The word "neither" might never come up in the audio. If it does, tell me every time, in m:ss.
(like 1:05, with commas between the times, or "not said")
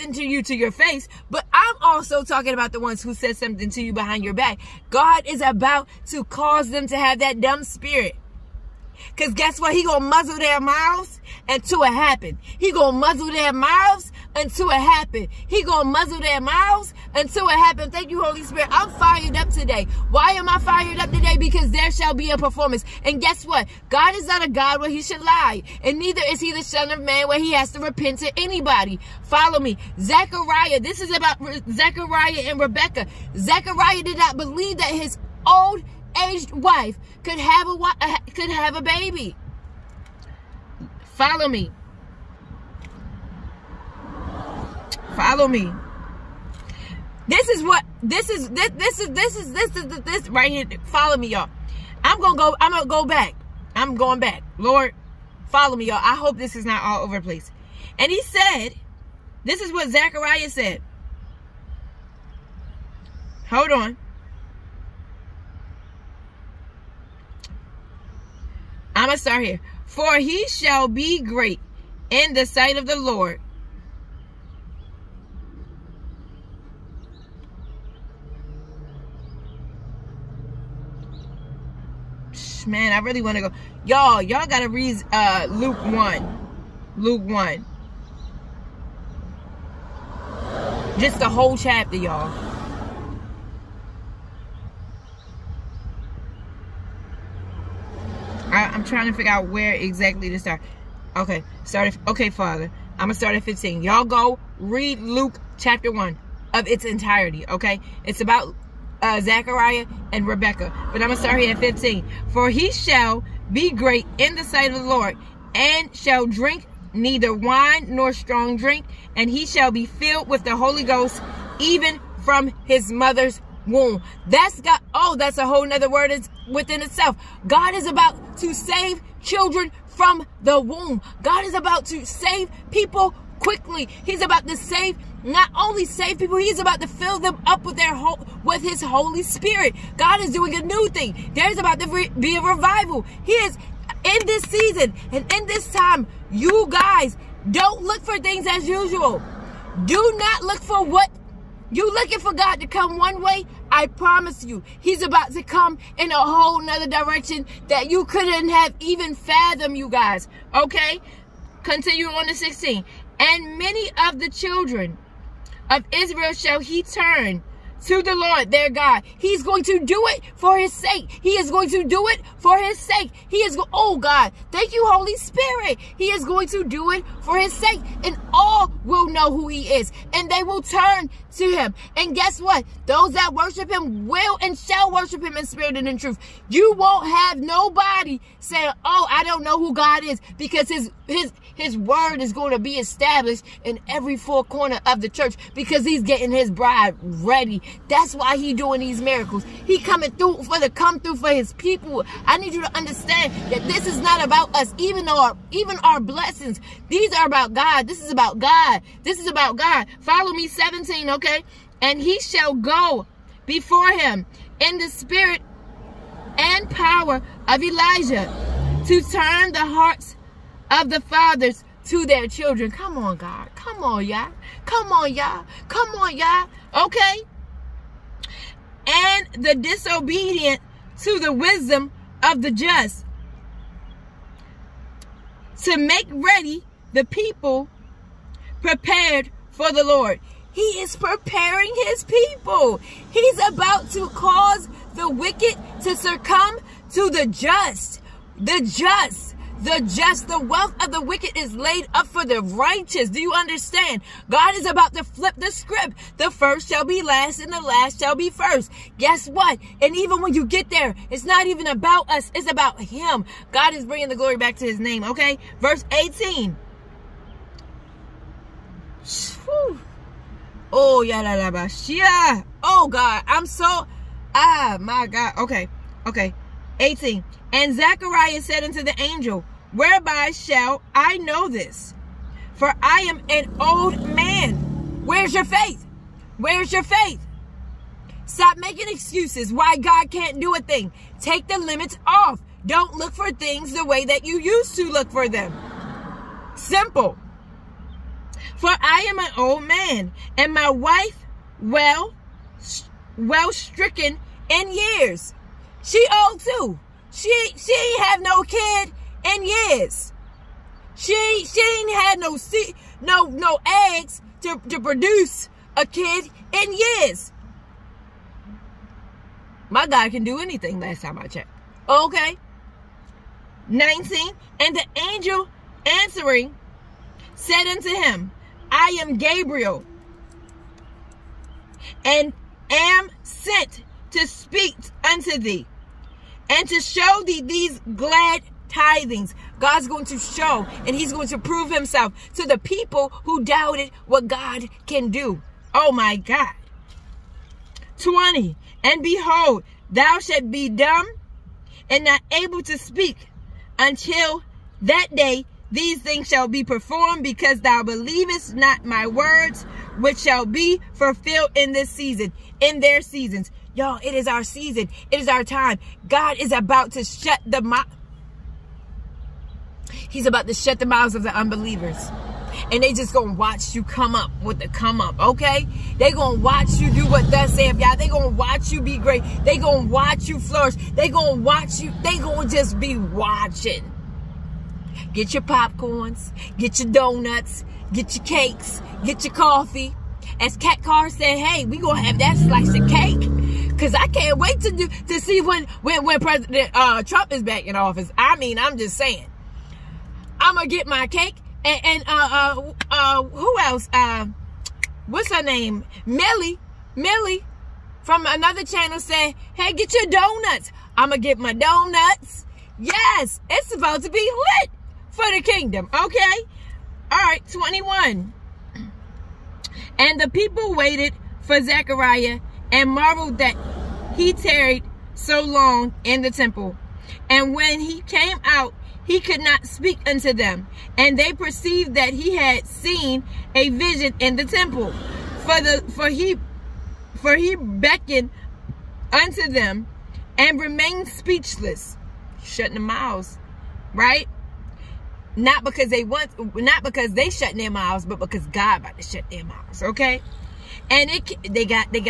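0:25, 1:56.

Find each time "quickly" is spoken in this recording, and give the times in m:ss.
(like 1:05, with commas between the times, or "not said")
2:13.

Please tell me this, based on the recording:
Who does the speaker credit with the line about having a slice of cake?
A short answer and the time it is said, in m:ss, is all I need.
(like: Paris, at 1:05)
Cat Carr, at 6:30.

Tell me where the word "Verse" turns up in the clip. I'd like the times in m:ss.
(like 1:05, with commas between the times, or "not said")
4:25.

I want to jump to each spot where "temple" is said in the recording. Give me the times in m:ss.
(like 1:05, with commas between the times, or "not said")
7:06, 7:14.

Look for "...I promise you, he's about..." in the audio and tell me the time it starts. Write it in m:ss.
2:33.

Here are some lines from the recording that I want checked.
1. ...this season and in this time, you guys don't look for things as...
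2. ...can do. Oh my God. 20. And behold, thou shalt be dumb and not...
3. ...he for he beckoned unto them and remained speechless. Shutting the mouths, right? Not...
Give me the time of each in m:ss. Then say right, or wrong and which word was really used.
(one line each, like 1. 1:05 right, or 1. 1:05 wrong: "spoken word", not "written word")
1. 2:24 right
2. 5:44 right
3. 7:16 right.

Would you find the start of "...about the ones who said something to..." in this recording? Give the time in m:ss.
0:02.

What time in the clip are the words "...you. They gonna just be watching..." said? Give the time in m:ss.
6:21.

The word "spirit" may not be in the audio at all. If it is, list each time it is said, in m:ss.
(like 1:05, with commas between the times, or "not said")
0:07, 0:18, 2:19, 2:55, 3:05, 3:34.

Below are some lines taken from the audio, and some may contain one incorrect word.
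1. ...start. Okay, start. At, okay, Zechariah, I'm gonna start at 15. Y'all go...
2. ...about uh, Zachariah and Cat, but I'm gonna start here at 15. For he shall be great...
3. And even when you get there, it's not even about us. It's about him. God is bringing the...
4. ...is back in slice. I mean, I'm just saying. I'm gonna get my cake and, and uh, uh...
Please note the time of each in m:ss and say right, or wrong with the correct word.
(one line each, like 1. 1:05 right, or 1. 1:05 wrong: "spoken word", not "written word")
1. 1:40 wrong: "Father", not "Zechariah"
2. 1:48 wrong: "Rebecca", not "Cat"
3. 4:19 right
4. 6:37 wrong: "office", not "slice".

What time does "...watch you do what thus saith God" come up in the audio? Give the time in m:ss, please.
6:16.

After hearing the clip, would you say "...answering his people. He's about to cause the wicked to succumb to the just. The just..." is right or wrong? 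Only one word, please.
wrong.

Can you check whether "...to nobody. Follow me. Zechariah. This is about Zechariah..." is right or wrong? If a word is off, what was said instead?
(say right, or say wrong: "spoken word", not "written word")
wrong: "anybody", not "nobody".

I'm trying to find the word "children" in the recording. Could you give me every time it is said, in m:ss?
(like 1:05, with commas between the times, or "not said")
2:09, 2:44, 3:42.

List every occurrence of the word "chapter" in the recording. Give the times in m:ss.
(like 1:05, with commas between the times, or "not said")
1:31, 1:45.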